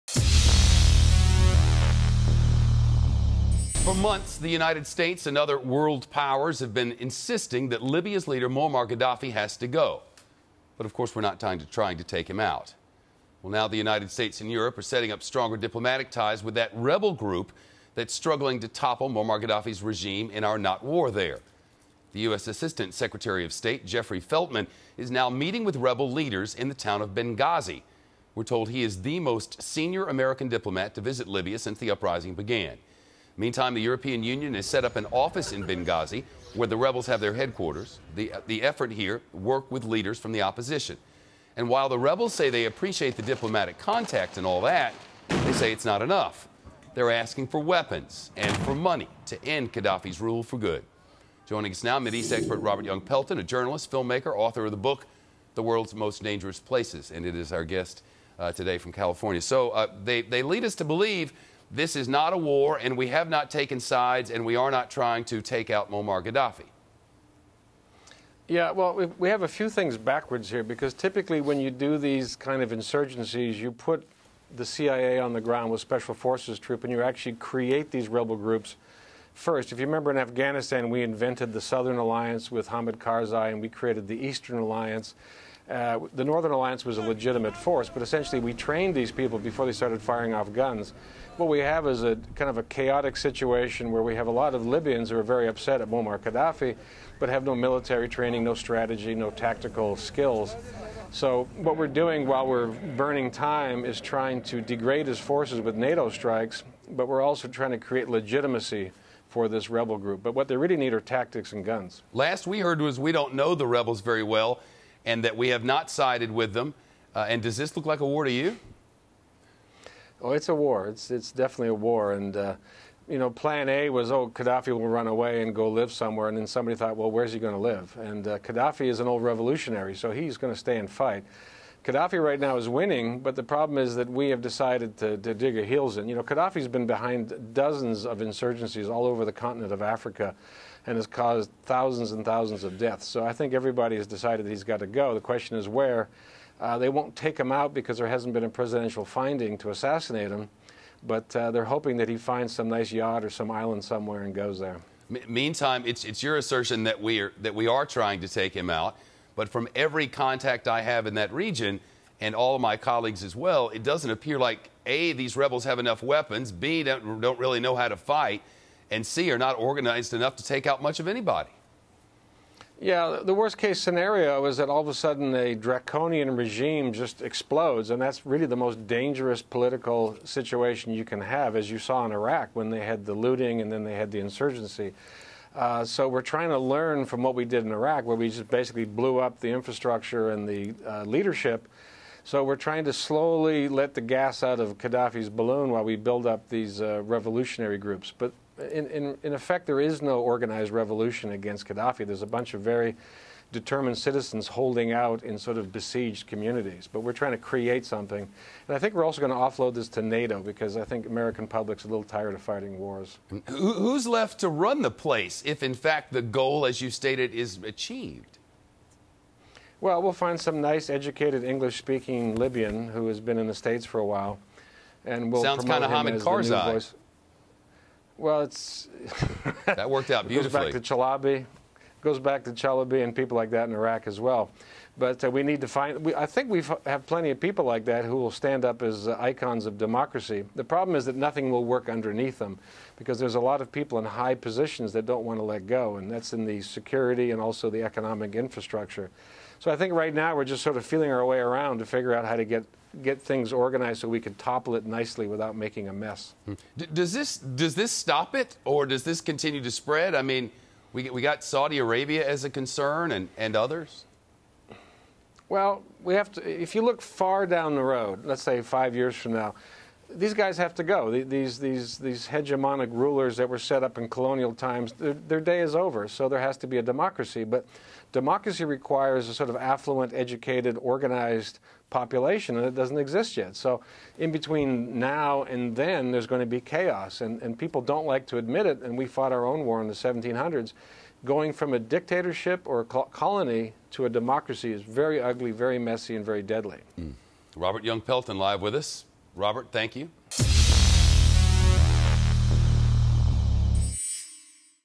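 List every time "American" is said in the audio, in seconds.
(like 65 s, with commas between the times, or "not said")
30 s, 211 s.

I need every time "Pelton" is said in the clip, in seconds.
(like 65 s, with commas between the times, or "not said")
53 s, 298 s.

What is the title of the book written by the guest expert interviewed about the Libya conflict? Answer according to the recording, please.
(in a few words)
The World's Most Dangerous Places.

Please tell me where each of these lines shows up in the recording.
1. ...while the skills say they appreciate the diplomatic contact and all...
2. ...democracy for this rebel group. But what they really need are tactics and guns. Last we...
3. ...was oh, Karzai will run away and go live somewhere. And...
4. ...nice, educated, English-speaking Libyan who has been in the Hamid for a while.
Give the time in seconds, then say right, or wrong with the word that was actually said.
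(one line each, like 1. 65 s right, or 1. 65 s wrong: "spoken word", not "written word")
1. 41 s wrong: "rebels", not "skills"
2. 108 s wrong: "legitimacy", not "democracy"
3. 123 s wrong: "Gaddafi", not "Karzai"
4. 220 s wrong: "States", not "Hamid".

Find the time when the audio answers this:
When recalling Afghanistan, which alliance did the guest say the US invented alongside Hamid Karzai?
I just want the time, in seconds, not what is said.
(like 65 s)
81 s.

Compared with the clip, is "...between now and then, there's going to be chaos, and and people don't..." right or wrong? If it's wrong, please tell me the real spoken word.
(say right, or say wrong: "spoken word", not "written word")
right.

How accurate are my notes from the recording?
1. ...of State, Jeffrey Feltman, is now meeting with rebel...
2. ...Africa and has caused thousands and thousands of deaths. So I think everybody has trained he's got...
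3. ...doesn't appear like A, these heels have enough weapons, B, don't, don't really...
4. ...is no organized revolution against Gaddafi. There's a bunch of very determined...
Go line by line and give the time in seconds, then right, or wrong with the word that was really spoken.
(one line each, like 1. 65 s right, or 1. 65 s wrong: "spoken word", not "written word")
1. 23 s right
2. 139 s wrong: "decided", not "trained"
3. 163 s wrong: "rebels", not "heels"
4. 199 s right.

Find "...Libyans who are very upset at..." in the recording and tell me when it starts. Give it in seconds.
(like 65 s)
94 s.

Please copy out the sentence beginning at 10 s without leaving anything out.
But of course, we're not trying to, trying to take him out.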